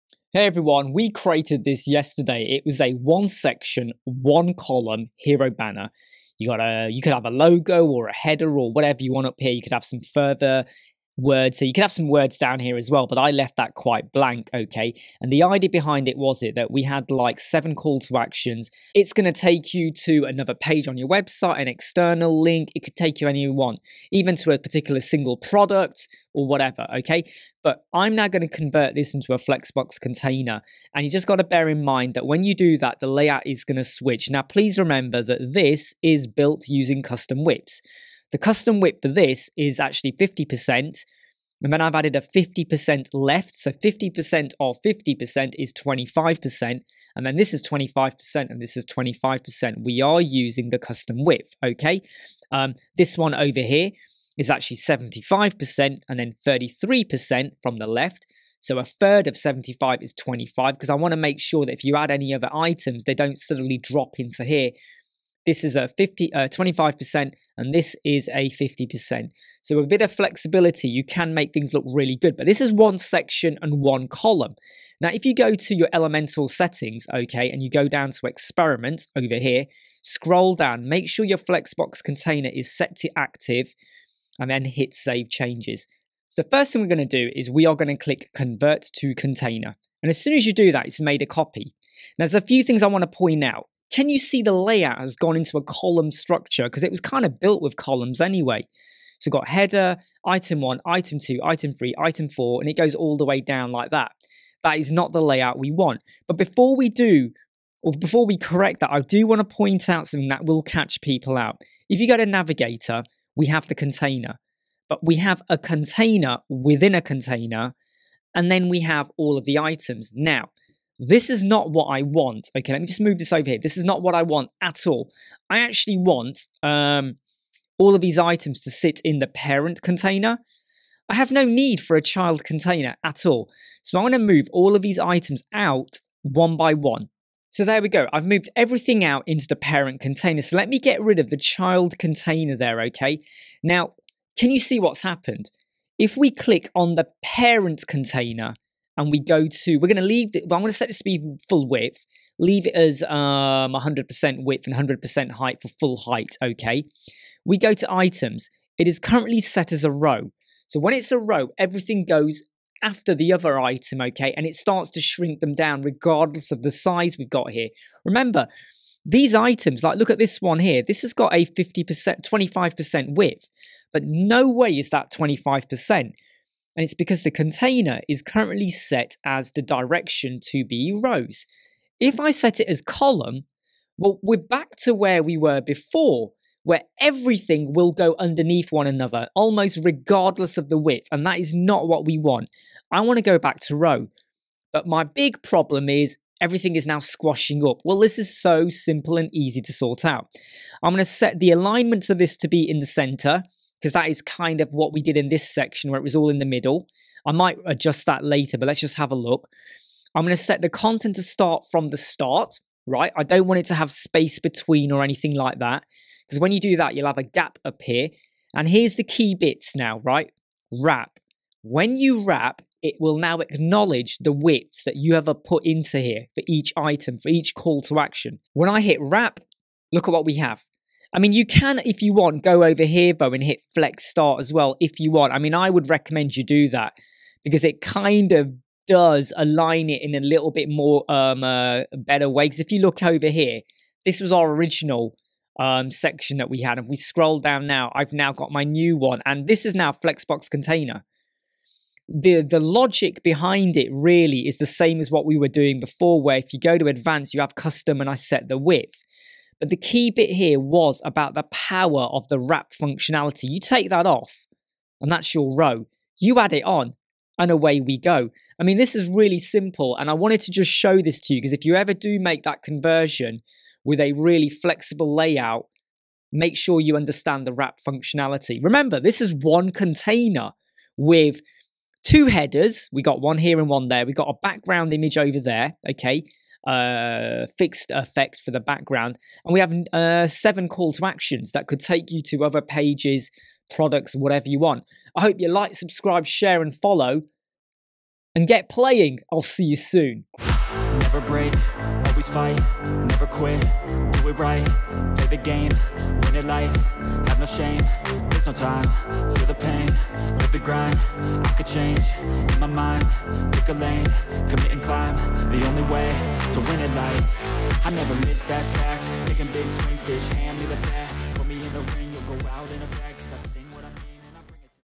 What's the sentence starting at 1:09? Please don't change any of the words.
So a bit of flexibility, you can make things look really good.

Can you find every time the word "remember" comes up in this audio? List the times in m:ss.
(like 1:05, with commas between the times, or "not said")
0:34, 2:48, 4:38.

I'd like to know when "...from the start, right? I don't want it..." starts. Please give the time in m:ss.
3:31.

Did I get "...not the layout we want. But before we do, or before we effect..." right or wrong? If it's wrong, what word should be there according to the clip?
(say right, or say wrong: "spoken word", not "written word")
wrong: "correct", not "effect".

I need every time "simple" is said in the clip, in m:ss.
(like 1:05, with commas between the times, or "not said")
3:18, 4:29.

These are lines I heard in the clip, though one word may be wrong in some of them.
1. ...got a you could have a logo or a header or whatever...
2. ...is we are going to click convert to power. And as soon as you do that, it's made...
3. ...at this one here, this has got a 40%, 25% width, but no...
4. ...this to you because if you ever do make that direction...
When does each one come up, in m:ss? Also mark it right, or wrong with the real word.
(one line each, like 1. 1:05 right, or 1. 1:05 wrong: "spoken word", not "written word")
1. 0:06 right
2. 1:27 wrong: "container", not "power"
3. 2:50 wrong: "50", not "40"
4. 4:31 wrong: "conversion", not "direction".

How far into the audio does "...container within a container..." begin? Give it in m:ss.
1:55.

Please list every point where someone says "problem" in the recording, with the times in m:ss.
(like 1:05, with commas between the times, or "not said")
3:15.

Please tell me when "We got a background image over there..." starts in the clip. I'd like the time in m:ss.
4:44.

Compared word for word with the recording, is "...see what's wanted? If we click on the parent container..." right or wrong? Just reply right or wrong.
wrong.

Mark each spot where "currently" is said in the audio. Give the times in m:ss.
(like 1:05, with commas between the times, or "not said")
2:38, 2:58.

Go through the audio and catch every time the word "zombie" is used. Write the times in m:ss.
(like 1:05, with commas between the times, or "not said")
not said.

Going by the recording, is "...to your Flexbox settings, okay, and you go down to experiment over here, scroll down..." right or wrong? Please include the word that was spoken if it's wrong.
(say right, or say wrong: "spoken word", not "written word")
wrong: "Elementor", not "Flexbox".